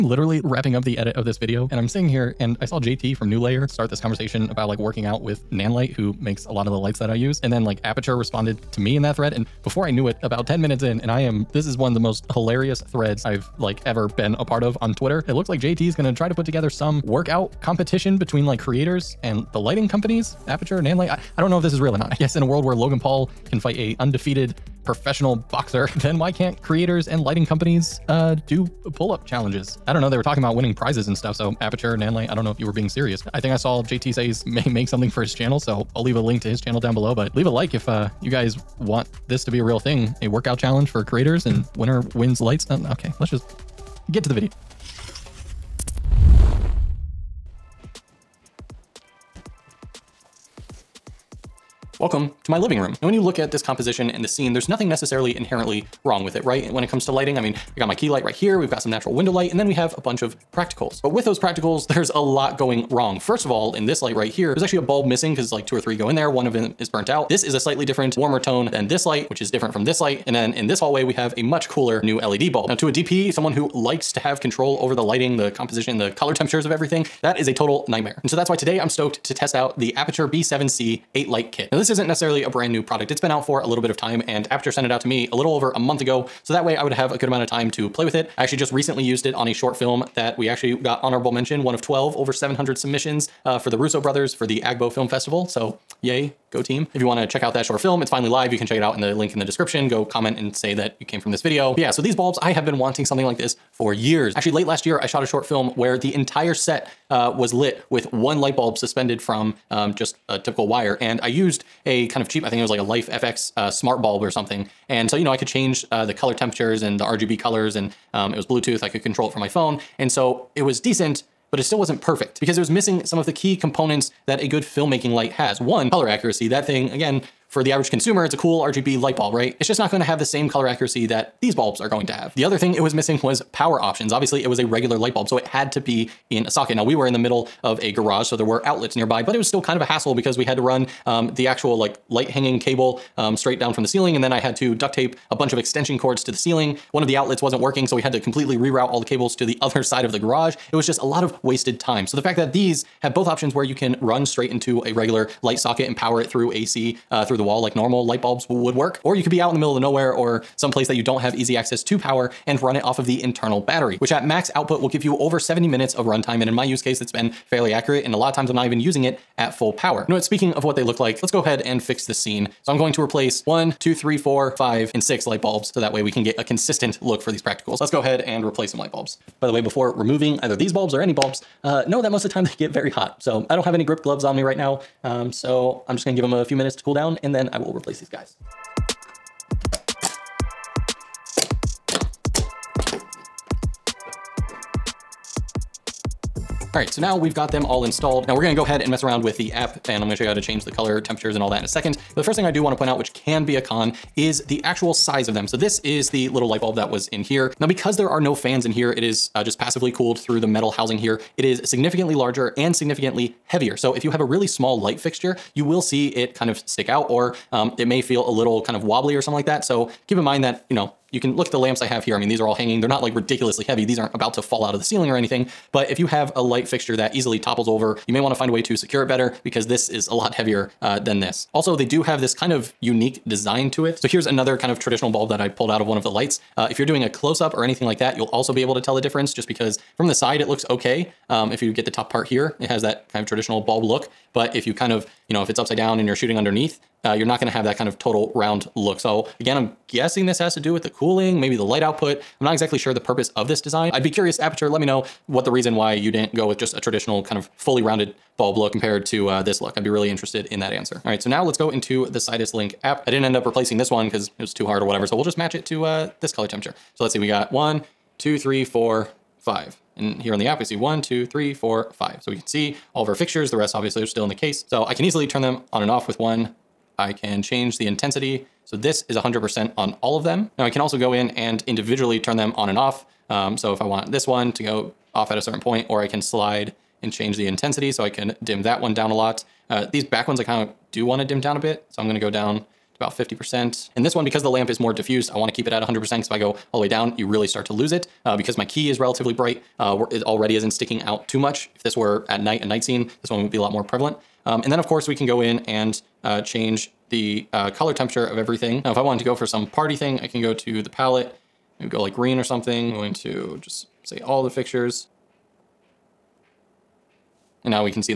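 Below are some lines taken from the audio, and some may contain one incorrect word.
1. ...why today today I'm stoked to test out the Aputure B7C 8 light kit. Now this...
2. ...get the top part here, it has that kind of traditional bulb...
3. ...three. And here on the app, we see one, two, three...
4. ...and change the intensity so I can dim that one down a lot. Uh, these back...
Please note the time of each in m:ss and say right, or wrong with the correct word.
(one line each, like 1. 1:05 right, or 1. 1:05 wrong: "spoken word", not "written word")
1. 1:18 right
2. 4:01 right
3. 4:29 wrong: "five", not "three"
4. 4:47 right.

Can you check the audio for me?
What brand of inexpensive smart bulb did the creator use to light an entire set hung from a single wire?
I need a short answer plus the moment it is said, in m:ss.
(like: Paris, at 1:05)
LIFX, at 1:52.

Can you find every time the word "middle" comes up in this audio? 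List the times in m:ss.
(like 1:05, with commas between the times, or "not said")
2:17, 2:39.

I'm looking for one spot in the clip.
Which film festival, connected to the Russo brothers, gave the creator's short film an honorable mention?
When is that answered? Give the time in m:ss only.
1:34.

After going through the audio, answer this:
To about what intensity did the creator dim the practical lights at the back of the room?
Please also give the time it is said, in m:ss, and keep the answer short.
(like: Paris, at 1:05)
50%, at 4:53.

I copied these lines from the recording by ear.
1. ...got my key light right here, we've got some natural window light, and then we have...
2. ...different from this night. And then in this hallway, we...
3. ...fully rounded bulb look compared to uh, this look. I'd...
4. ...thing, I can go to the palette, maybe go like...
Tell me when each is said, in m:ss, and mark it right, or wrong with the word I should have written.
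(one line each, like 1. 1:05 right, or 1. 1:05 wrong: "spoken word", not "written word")
1. 0:57 right
2. 1:09 wrong: "light", not "night"
3. 4:17 right
4. 5:09 right.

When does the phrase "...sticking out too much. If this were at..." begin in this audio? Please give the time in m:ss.
5:00.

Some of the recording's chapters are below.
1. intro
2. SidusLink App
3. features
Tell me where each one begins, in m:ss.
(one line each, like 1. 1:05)
1. 0:47
2. 4:20
3. 2:49.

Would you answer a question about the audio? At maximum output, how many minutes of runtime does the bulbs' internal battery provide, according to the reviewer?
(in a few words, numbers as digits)
over 70 minutes.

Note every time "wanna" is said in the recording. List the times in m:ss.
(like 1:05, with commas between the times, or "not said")
1:37, 3:22, 3:48, 4:55.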